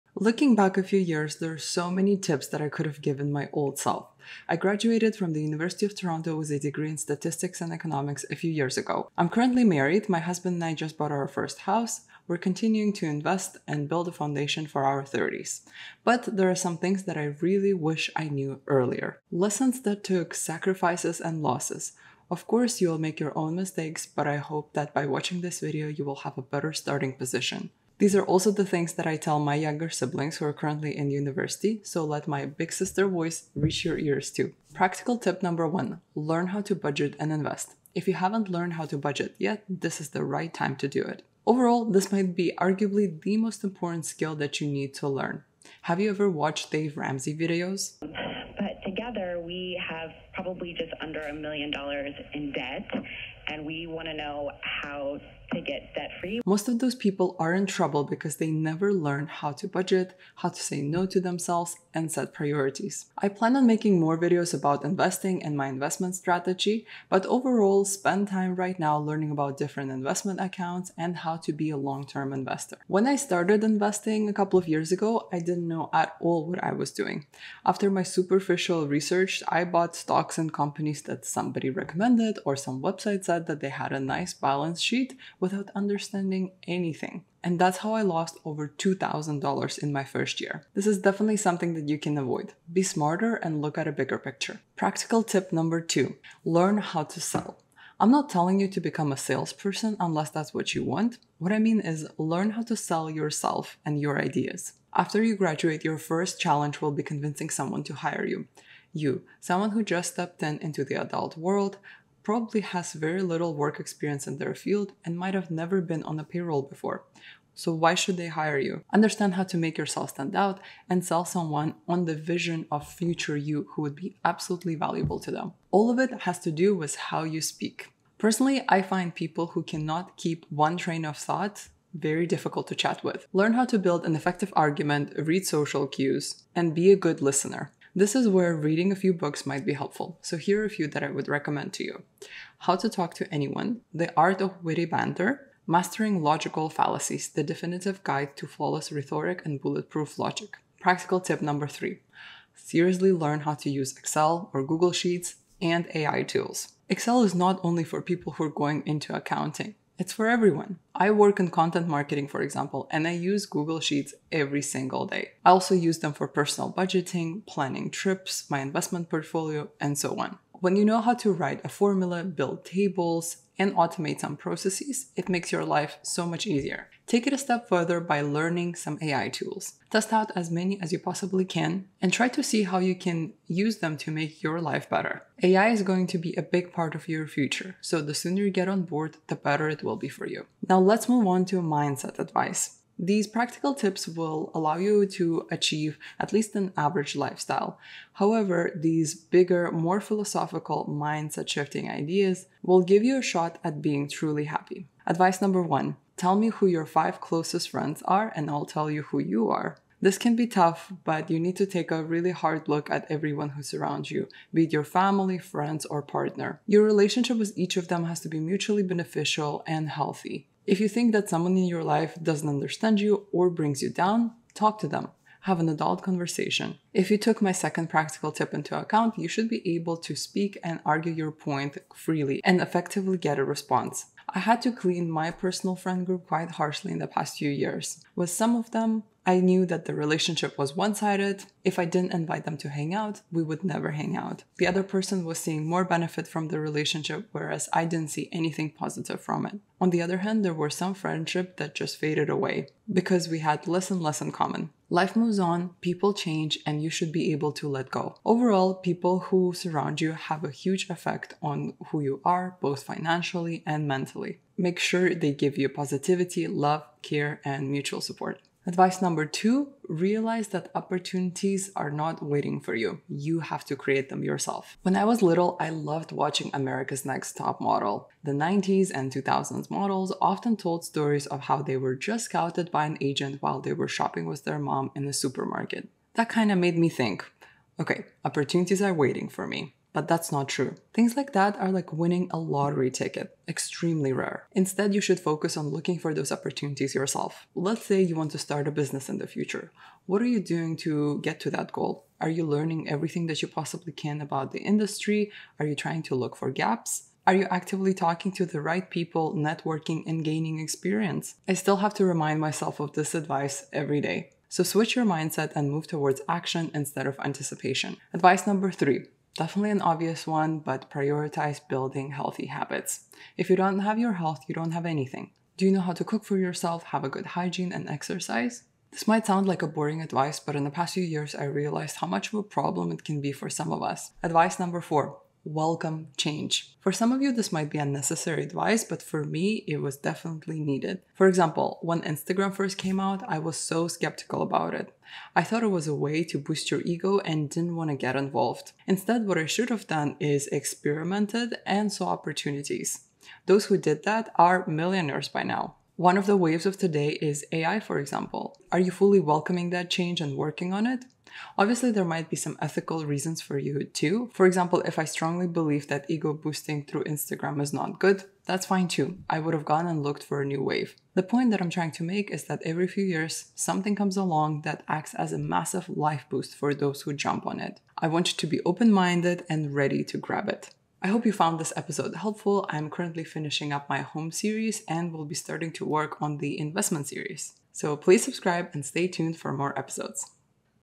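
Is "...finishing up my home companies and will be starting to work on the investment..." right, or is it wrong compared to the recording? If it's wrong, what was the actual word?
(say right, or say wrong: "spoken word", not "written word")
wrong: "series", not "companies".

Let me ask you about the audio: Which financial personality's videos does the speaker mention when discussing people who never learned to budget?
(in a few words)
Dave Ramsey.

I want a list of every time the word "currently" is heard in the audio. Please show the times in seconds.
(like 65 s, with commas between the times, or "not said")
9 s, 30 s, 382 s.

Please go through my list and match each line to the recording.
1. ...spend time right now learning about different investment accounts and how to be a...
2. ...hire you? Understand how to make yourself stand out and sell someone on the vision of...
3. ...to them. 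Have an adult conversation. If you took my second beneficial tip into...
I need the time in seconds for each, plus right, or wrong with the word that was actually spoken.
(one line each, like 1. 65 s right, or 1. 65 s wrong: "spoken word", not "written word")
1. 67 s right
2. 118 s right
3. 224 s wrong: "practical", not "beneficial".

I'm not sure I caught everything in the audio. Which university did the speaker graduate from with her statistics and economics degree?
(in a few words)
University of Toronto.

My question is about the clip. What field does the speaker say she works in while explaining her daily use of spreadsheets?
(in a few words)
content marketing.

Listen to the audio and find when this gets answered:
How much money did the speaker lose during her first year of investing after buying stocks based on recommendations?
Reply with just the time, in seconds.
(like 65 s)
88 s.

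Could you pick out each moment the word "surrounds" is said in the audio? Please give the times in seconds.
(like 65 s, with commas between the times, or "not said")
213 s, 259 s.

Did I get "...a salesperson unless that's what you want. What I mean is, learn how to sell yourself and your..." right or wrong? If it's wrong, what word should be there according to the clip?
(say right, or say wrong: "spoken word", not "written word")
right.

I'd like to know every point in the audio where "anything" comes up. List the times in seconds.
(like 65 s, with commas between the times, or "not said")
86 s, 248 s, 324 s.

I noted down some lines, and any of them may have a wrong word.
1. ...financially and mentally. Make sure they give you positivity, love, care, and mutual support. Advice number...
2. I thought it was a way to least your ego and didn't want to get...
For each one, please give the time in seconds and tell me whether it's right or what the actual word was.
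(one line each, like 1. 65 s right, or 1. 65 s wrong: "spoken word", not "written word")
1. 262 s right
2. 345 s wrong: "boost", not "least".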